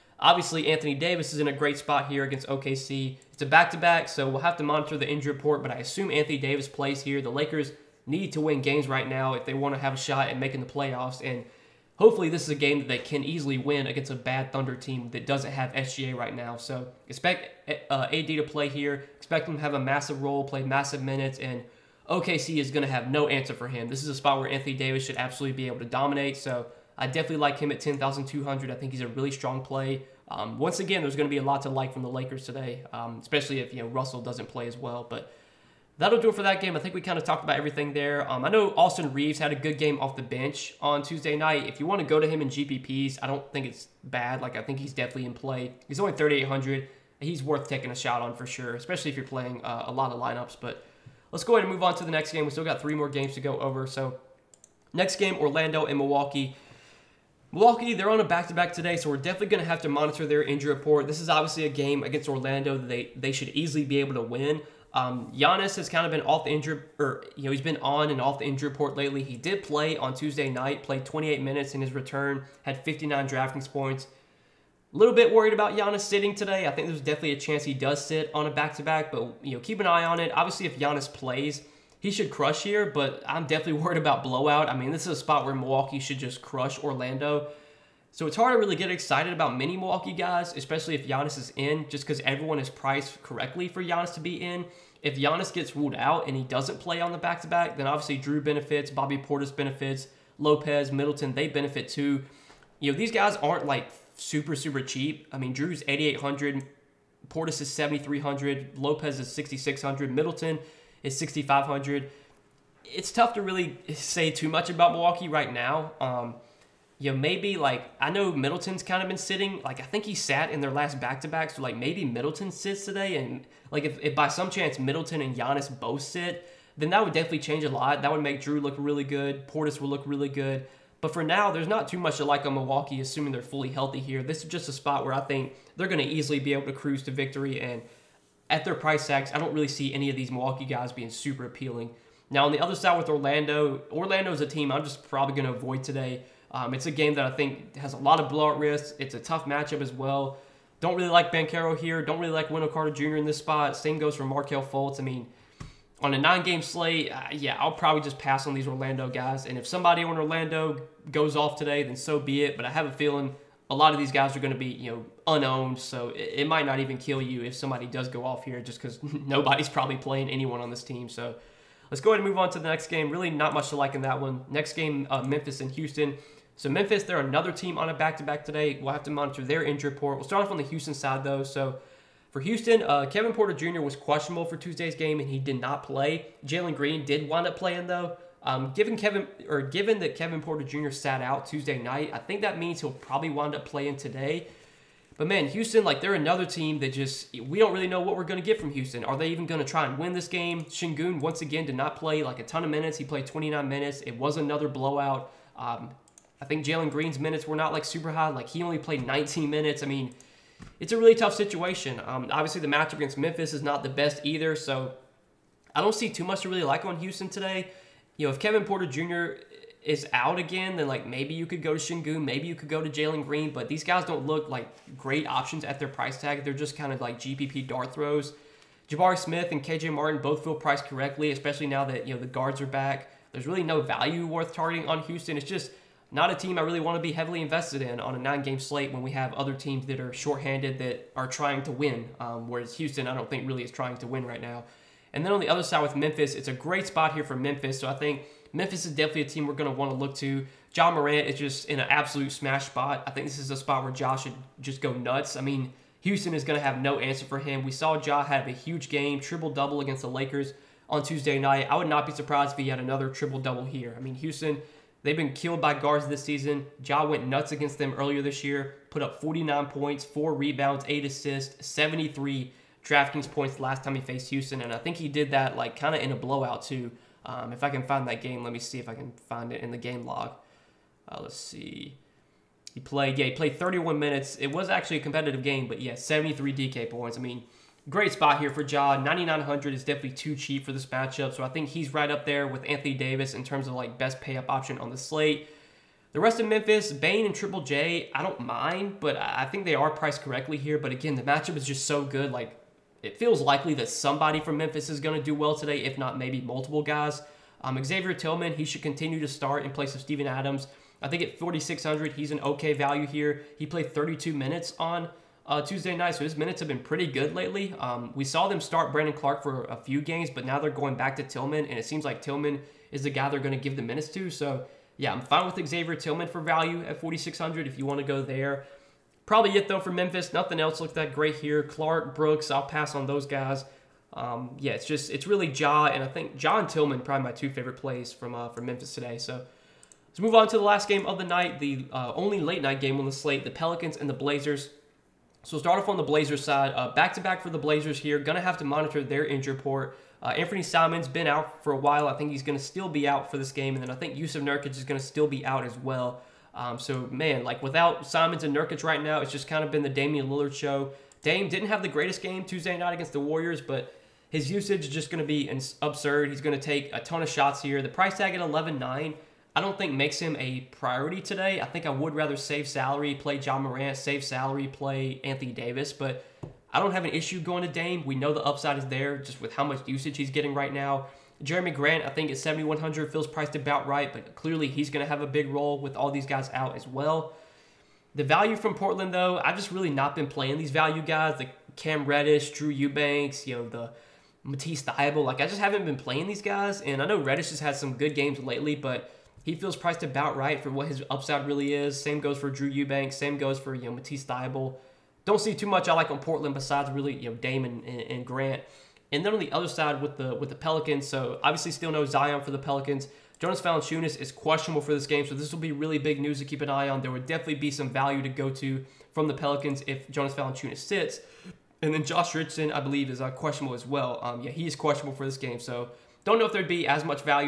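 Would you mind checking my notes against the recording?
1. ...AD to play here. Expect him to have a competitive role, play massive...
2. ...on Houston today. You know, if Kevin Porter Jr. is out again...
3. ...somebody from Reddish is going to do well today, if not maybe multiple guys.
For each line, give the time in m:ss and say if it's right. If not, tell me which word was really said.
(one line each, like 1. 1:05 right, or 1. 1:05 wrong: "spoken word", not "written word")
1. 0:18 wrong: "massive", not "competitive"
2. 3:36 right
3. 5:03 wrong: "Memphis", not "Reddish".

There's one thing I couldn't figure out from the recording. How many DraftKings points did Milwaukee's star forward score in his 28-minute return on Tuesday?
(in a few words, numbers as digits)
59.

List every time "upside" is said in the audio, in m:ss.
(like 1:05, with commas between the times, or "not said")
6:18, 6:41.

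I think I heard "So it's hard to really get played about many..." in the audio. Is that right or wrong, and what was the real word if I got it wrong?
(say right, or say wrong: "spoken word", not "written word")
wrong: "excited", not "played".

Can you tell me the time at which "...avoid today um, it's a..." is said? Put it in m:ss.
2:25.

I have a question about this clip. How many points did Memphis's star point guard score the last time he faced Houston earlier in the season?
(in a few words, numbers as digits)
49.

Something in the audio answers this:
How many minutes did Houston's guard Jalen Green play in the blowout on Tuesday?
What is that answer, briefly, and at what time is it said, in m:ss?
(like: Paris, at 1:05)
19, at 3:29.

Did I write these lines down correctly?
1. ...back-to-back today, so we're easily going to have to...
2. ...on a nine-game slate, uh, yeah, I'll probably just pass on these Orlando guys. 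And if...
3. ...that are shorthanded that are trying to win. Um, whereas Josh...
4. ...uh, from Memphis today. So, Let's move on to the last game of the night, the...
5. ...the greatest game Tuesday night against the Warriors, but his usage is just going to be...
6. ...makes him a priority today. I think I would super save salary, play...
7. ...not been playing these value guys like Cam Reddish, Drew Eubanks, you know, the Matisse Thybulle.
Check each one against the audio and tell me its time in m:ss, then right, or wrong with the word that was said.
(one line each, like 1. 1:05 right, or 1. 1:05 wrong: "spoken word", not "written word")
1. 0:58 wrong: "definitely", not "easily"
2. 2:36 right
3. 3:59 wrong: "Houston", not "Josh"
4. 5:38 right
5. 6:01 right
6. 6:09 wrong: "rather", not "super"
7. 6:29 right.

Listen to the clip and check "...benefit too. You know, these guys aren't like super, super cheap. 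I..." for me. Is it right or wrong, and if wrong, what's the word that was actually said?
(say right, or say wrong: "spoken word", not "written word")
right.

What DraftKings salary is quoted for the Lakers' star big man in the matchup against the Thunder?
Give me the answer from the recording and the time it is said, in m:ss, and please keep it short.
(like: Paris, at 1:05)
10,200, at 0:27.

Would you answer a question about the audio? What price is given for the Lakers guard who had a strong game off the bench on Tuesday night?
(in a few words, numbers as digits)
3,800.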